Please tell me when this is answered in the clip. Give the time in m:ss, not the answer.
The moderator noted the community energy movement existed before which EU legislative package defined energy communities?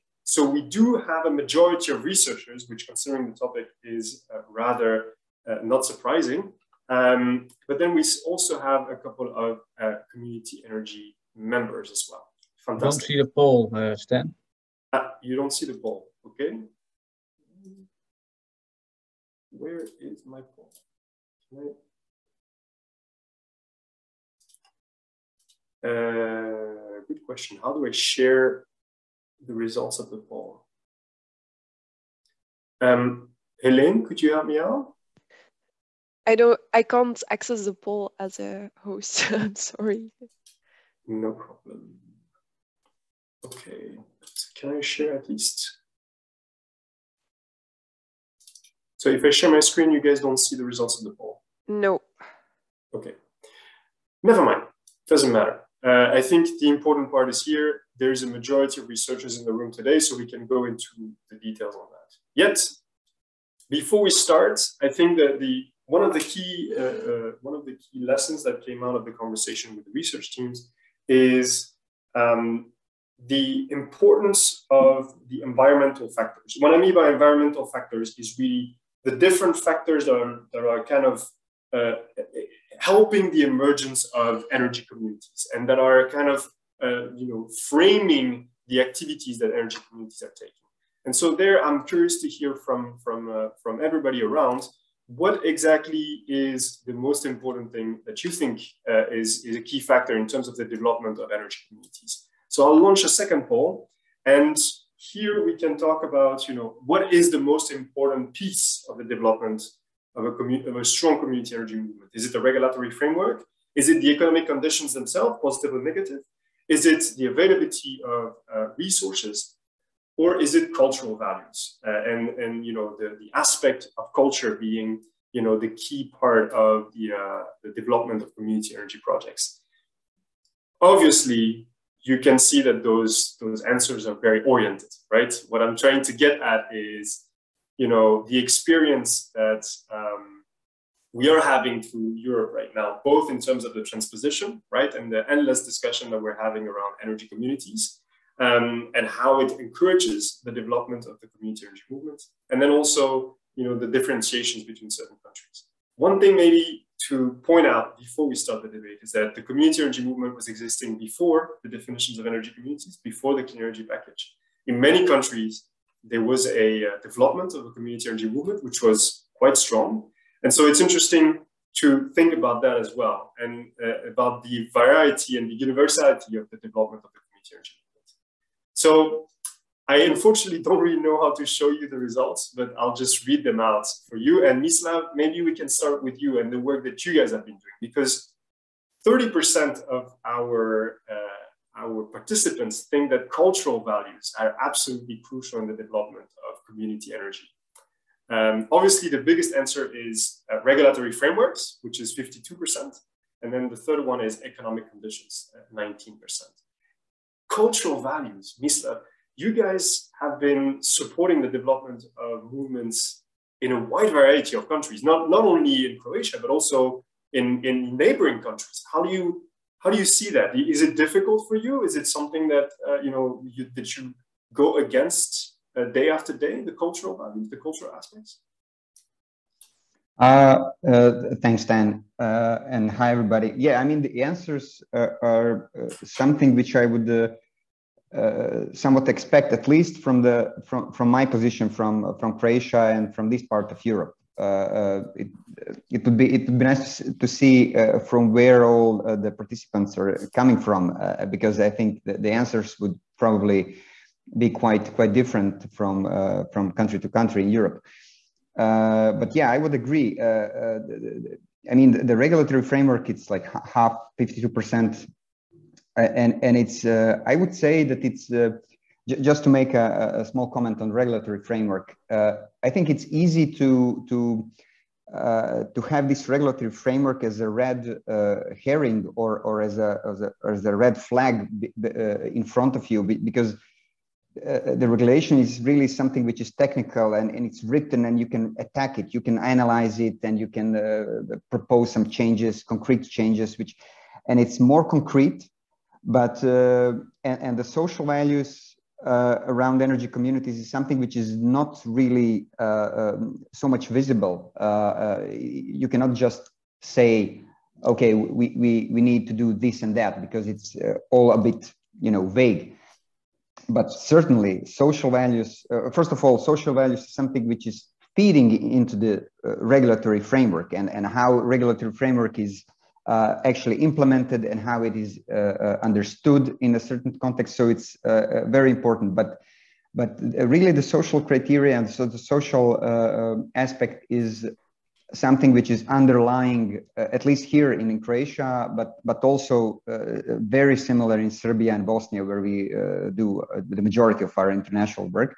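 2:43.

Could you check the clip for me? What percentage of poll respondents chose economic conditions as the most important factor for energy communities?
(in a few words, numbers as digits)
19%.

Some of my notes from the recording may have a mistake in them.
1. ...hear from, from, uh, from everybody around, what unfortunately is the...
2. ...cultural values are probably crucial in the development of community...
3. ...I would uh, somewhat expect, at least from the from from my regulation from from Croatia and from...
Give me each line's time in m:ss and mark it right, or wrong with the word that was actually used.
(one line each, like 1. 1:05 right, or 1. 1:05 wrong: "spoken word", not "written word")
1. 1:32 wrong: "exactly", not "unfortunately"
2. 3:13 wrong: "absolutely", not "probably"
3. 3:56 wrong: "position", not "regulation".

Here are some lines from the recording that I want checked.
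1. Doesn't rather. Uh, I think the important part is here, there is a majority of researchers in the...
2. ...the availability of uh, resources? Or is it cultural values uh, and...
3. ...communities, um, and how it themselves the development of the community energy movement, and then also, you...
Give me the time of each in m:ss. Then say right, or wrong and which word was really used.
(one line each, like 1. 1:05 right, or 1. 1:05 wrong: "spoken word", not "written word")
1. 0:55 wrong: "matter", not "rather"
2. 1:57 right
3. 2:27 wrong: "encourages", not "themselves".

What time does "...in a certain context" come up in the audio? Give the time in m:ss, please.
5:26.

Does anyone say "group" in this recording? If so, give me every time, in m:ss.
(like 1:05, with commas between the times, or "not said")
not said.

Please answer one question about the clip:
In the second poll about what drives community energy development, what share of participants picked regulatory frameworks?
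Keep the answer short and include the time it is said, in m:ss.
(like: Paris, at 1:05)
52%, at 3:22.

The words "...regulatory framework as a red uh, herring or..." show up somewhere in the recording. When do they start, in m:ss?
4:36.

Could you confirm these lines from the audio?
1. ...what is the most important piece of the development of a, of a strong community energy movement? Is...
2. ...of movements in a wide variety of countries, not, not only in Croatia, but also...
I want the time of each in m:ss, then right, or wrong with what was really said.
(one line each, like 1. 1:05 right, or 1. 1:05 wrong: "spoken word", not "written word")
1. 1:46 right
2. 3:32 right.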